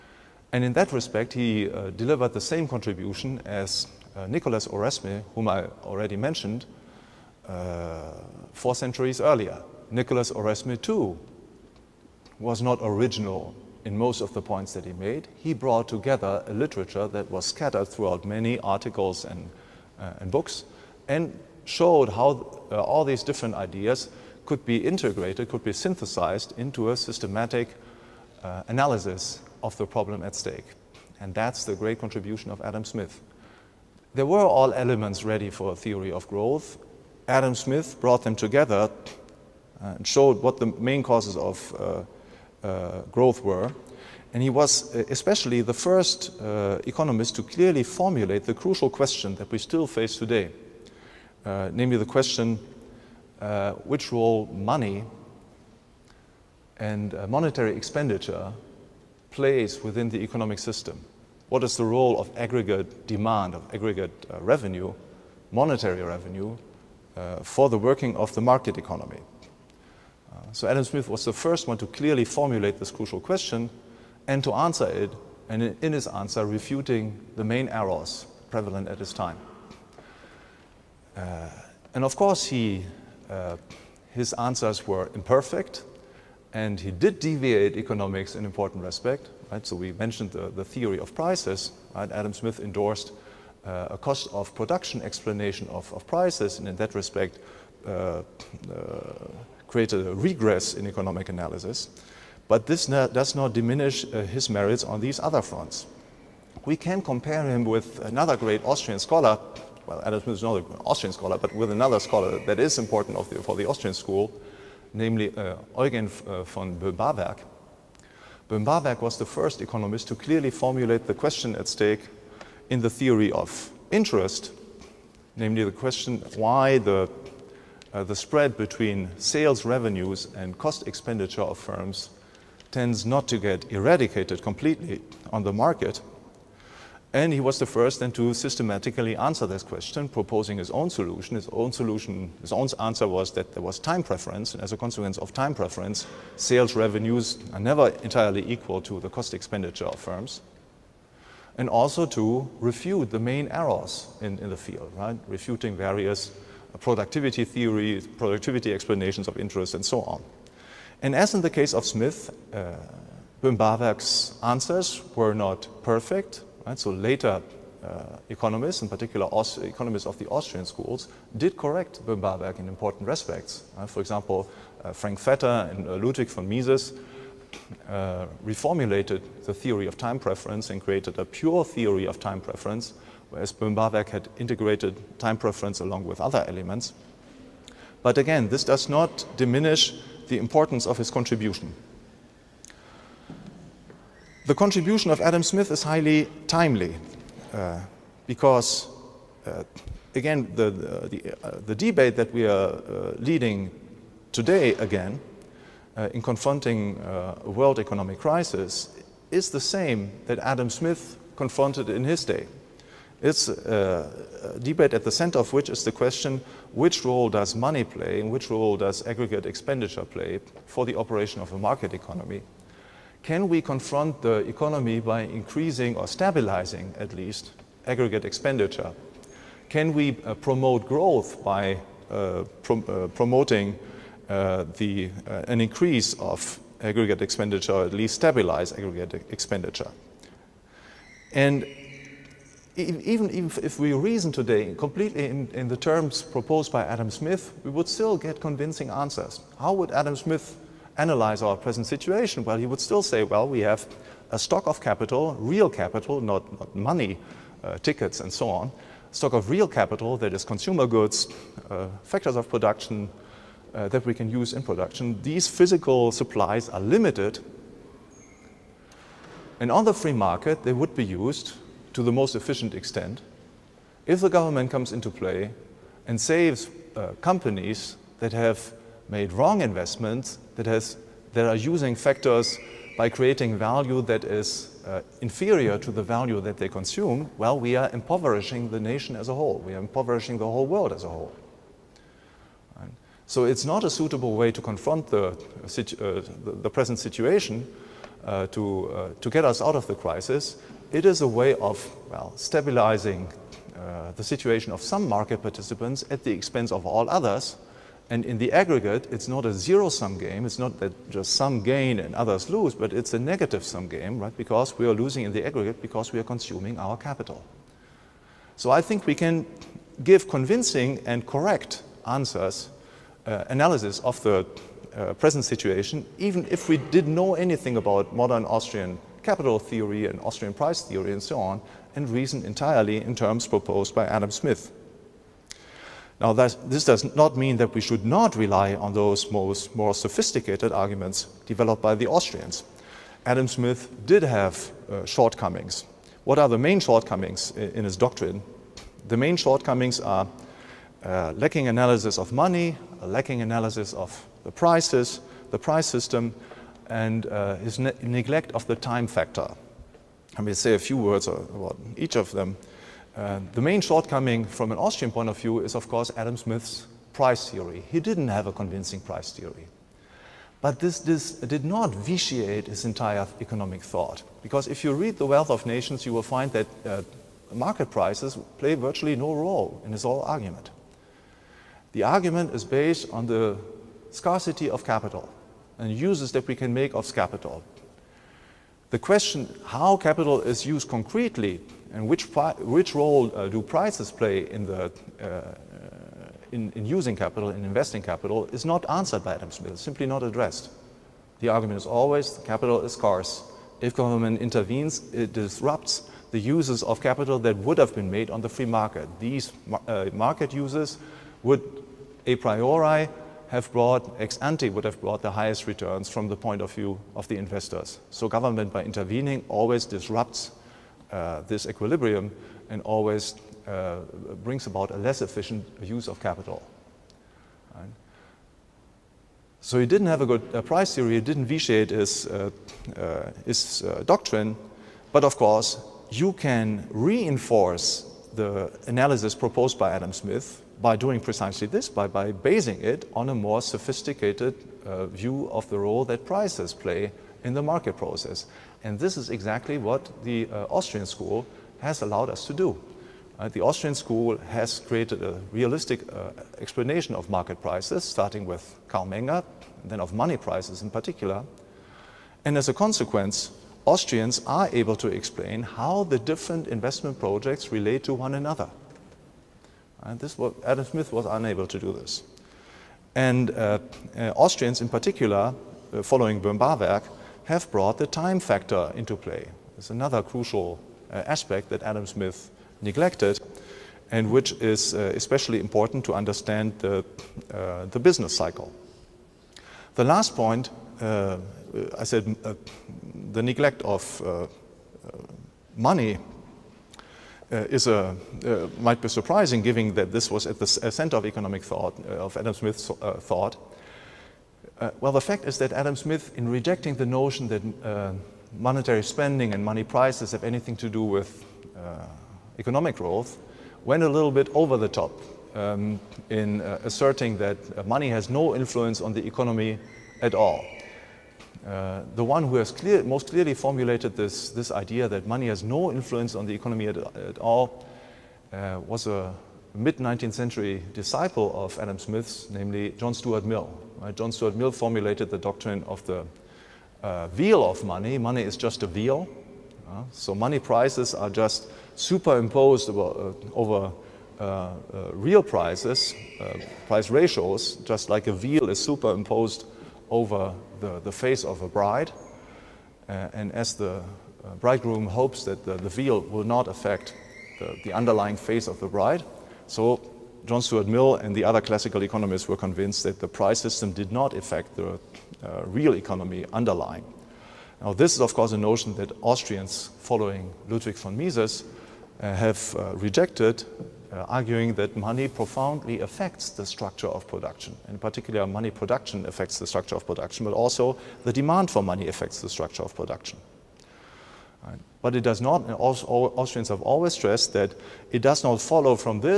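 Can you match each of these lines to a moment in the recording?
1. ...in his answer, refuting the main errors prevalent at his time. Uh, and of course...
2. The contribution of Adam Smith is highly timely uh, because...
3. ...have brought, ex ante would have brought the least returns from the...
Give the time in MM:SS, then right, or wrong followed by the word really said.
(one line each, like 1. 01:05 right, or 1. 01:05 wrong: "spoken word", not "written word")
1. 01:15 right
2. 03:14 right
3. 06:53 wrong: "highest", not "least".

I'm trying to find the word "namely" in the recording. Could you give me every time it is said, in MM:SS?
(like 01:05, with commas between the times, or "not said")
00:51, 01:54, 02:05, 08:52.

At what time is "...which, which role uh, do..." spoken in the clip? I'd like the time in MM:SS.
06:32.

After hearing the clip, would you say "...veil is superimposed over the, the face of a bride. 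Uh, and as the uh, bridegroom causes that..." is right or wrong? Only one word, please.
wrong.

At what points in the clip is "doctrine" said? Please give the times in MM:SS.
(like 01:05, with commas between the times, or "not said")
05:47, 07:14, 08:55.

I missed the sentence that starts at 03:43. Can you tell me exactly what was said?
Can we confront the economy by increasing or stabilizing, at least, aggregate expenditure?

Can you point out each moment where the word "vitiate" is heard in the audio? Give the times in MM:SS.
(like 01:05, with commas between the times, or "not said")
06:11, 07:11.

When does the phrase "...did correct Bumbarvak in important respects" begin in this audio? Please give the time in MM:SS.
02:51.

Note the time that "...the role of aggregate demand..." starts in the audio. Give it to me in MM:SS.
01:01.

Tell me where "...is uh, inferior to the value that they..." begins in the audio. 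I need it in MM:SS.
04:44.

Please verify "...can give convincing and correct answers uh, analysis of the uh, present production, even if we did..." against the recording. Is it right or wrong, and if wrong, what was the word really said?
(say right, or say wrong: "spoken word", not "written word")
wrong: "situation", not "production".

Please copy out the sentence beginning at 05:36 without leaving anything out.
Now, this does not mean that we should not rely on those most, more sophisticated arguments developed by the Austrians.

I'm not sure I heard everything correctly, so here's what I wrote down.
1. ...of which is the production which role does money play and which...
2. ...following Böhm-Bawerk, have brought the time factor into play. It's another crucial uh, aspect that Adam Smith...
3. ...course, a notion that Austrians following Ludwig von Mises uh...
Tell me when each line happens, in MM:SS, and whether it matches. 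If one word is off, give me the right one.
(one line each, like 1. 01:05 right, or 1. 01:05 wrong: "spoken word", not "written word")
1. 03:35 wrong: "question", not "production"
2. 07:56 right
3. 09:28 right.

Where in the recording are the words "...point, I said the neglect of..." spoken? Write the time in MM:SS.
08:10.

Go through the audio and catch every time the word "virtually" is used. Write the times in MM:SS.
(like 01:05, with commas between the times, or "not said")
06:18.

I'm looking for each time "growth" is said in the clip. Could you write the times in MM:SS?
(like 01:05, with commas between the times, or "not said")
00:36, 00:43, 03:50, 08:32.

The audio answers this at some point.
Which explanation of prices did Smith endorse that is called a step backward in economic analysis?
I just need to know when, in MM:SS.
01:33.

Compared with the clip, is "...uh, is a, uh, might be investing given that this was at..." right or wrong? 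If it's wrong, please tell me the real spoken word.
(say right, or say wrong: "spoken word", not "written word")
wrong: "surprising", not "investing".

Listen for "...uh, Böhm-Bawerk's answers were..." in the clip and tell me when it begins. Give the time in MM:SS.
02:42.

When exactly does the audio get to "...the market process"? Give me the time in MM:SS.
07:27.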